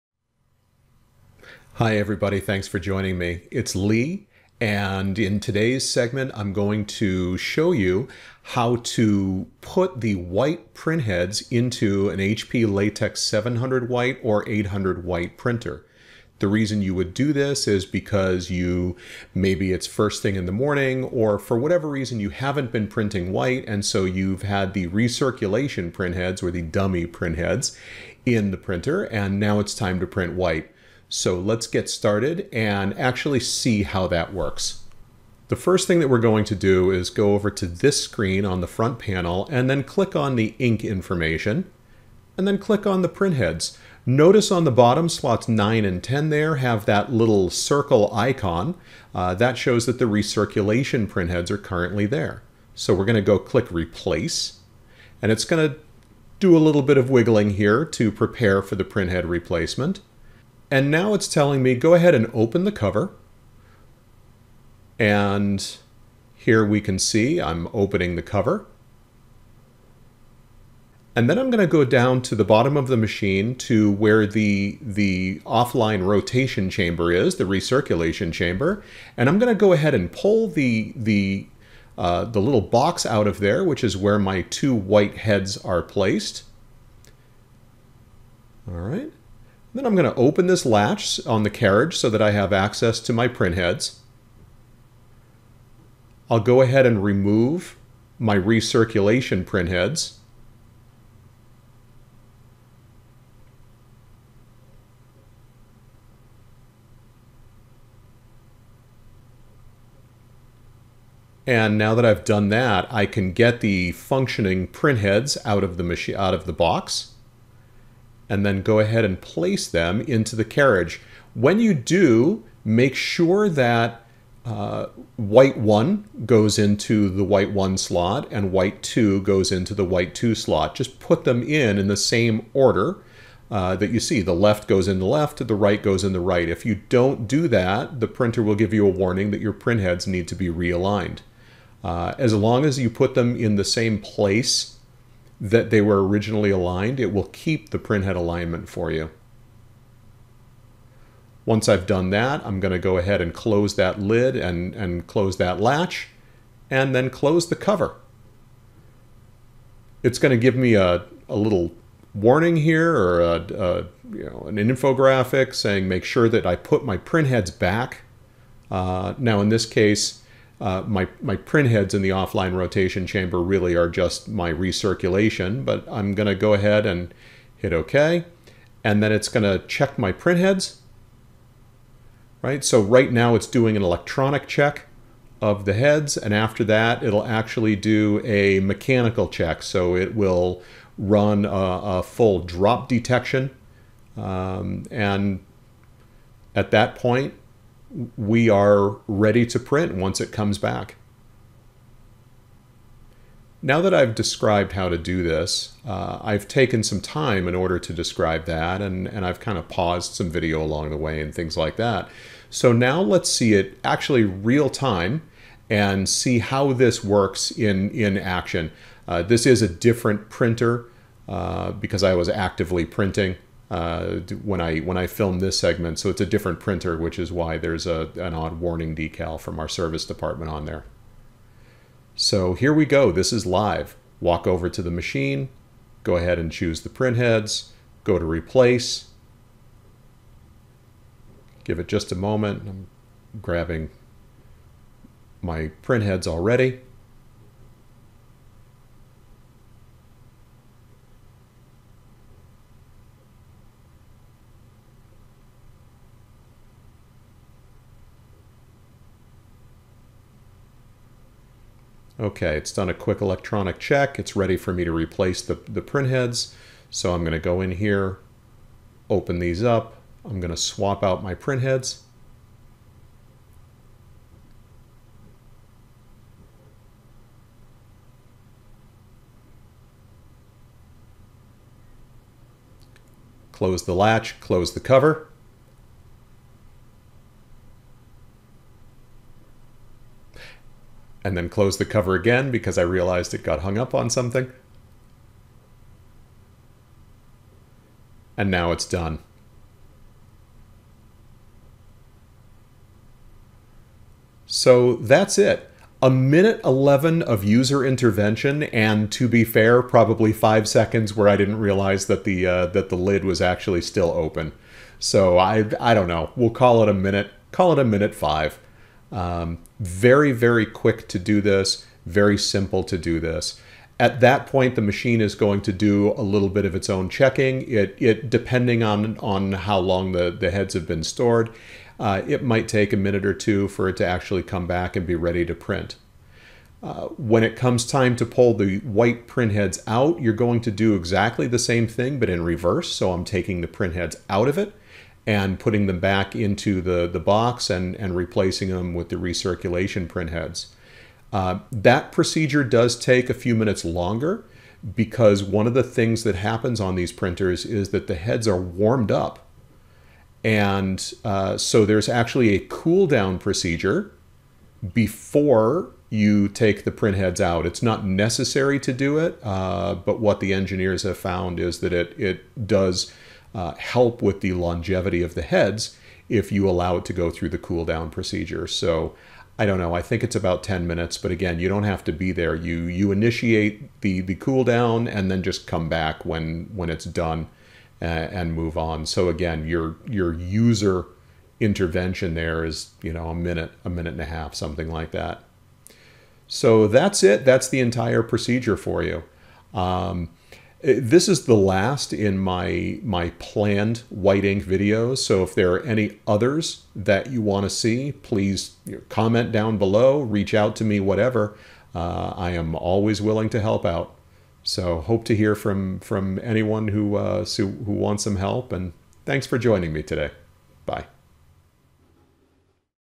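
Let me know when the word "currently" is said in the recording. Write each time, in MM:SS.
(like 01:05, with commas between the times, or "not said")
00:51.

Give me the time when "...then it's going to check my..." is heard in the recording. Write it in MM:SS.
02:59.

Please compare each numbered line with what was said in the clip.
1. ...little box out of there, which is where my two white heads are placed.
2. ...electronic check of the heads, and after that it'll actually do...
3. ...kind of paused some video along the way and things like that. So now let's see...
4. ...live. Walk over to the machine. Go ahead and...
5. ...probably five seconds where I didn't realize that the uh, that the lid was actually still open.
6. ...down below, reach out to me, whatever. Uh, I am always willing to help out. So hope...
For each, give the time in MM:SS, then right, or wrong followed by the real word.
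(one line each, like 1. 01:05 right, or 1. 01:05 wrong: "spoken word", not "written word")
1. 01:22 right
2. 03:03 right
3. 03:29 right
4. 03:53 right
5. 05:09 right
6. 06:49 right.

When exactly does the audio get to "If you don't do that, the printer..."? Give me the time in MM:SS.
02:16.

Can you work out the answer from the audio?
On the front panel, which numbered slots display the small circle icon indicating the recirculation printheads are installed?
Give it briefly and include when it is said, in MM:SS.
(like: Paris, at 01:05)
9 and 10, at 00:45.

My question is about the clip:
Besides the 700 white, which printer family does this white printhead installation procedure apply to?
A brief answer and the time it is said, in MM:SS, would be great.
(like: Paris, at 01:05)
800 white, at 00:14.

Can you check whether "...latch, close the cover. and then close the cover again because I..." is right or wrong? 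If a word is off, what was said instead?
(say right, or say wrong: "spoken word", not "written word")
right.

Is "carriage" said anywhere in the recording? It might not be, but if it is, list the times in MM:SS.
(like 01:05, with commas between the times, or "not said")
01:31, 02:00.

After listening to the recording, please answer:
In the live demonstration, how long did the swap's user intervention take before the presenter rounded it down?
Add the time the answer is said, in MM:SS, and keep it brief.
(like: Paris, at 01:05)
1 minute 11, at 05:06.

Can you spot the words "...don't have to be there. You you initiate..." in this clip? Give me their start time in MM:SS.
06:21.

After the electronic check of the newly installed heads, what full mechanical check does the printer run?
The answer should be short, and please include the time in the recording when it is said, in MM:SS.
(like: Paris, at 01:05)
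drop detection, at 03:12.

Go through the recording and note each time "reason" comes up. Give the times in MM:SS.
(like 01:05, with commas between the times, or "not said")
00:16, 00:21.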